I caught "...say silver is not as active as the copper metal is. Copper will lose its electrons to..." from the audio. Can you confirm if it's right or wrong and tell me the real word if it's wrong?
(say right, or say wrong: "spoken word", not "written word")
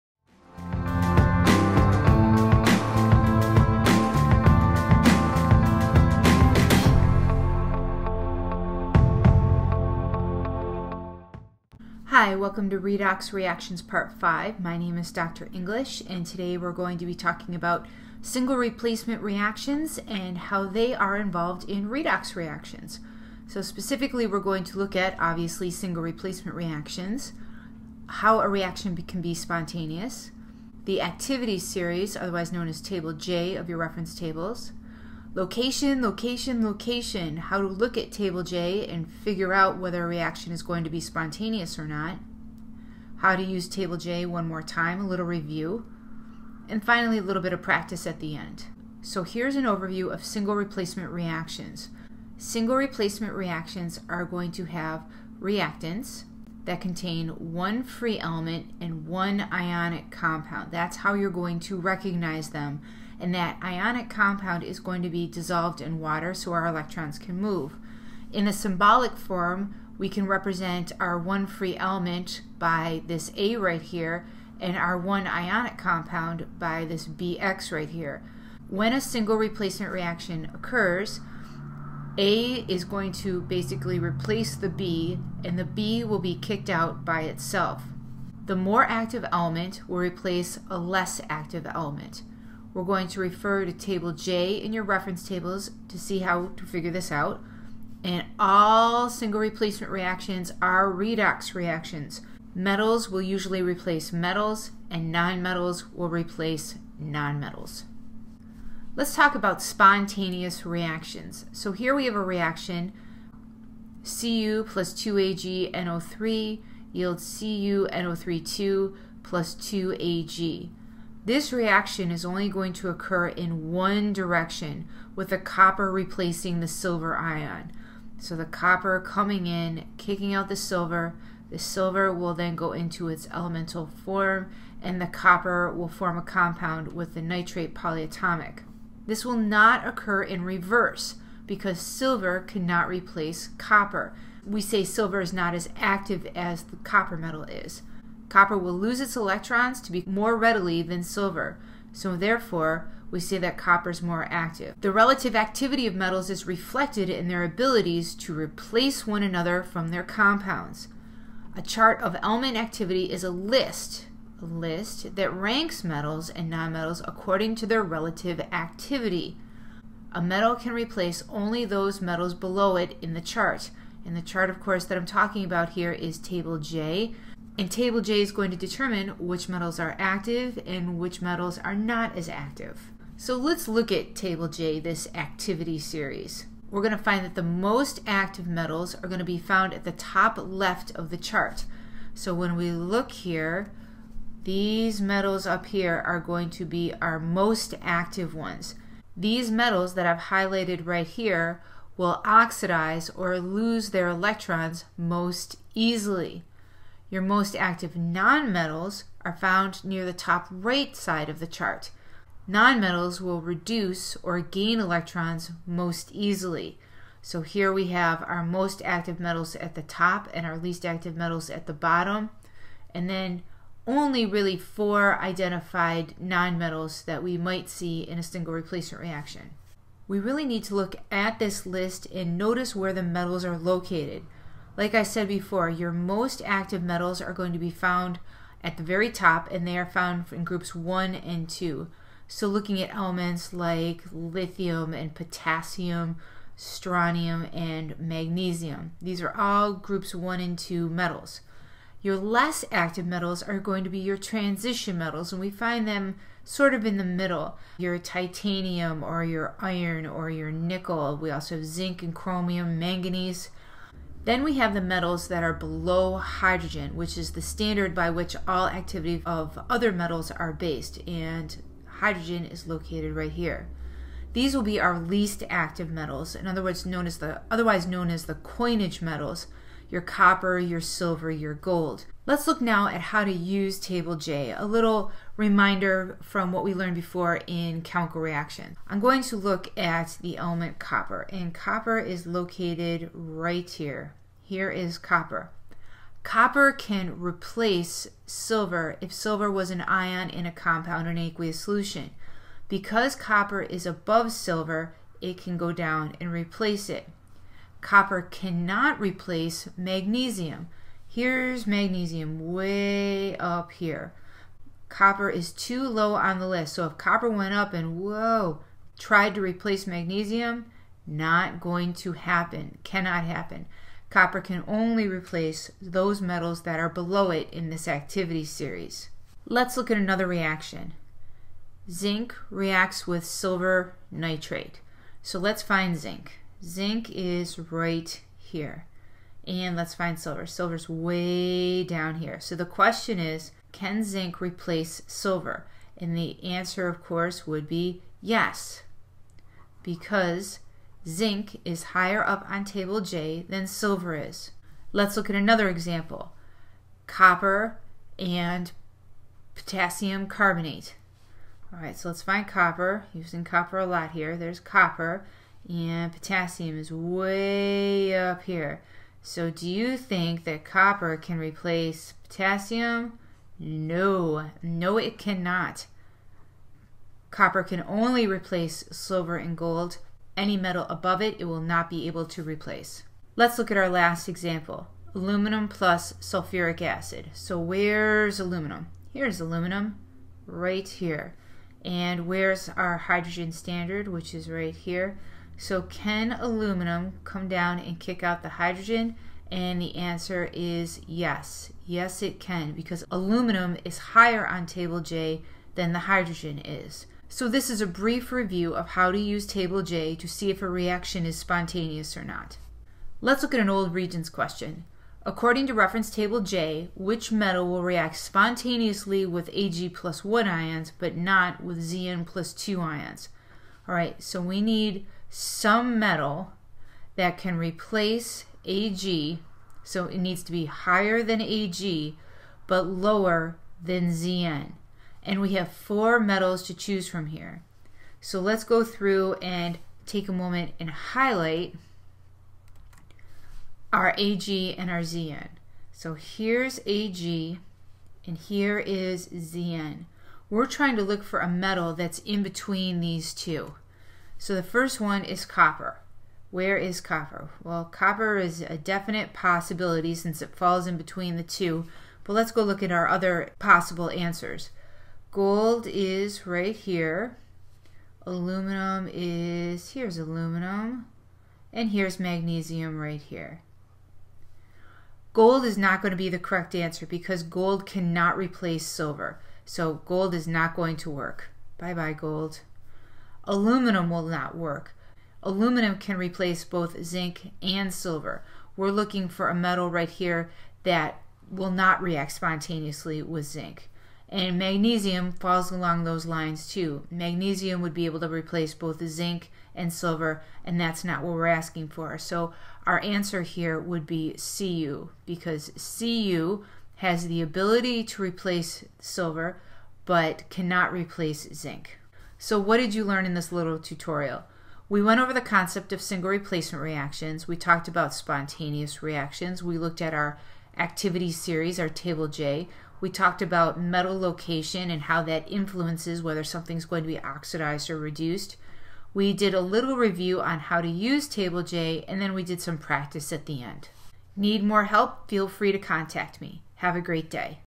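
right.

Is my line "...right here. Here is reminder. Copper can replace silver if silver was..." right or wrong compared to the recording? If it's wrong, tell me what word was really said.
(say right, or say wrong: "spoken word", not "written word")
wrong: "copper", not "reminder".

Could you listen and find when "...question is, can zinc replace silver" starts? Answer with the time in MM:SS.
05:42.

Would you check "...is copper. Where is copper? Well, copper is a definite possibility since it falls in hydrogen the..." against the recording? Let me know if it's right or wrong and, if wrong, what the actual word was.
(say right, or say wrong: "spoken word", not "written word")
wrong: "between", not "hydrogen".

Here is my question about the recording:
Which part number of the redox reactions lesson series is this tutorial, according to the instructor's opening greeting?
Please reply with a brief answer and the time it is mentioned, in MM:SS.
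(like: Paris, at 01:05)
Part 5, at 00:13.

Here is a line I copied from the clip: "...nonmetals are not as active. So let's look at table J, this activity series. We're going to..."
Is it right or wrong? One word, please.
wrong.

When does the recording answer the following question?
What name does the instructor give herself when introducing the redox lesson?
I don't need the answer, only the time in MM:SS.
00:15.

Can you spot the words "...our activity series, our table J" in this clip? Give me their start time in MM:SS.
08:40.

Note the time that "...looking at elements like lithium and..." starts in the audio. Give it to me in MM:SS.
04:02.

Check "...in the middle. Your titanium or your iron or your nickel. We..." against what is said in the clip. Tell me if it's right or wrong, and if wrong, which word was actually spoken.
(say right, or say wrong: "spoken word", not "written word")
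right.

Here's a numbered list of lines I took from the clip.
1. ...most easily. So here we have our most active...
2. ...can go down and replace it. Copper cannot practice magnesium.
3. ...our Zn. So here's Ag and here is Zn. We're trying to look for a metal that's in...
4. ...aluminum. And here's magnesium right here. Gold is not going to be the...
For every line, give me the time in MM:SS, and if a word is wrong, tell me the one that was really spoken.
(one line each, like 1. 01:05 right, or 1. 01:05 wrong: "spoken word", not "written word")
1. 03:35 right
2. 05:05 wrong: "replace", not "practice"
3. 07:24 right
4. 07:50 right.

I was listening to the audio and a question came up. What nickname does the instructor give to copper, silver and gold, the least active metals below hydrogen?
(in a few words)
coinage metals.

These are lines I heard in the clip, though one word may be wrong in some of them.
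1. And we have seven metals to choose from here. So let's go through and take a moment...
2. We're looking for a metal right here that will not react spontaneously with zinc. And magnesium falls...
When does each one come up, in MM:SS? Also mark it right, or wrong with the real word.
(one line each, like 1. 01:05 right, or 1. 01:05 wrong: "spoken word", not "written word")
1. 07:15 wrong: "four", not "seven"
2. 08:08 right.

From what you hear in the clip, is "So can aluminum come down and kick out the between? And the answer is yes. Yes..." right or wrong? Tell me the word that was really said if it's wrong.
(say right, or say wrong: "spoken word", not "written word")
wrong: "hydrogen", not "between".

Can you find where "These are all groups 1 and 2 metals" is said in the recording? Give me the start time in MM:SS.
04:08.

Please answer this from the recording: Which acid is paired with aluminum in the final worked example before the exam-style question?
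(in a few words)
sulfuric acid.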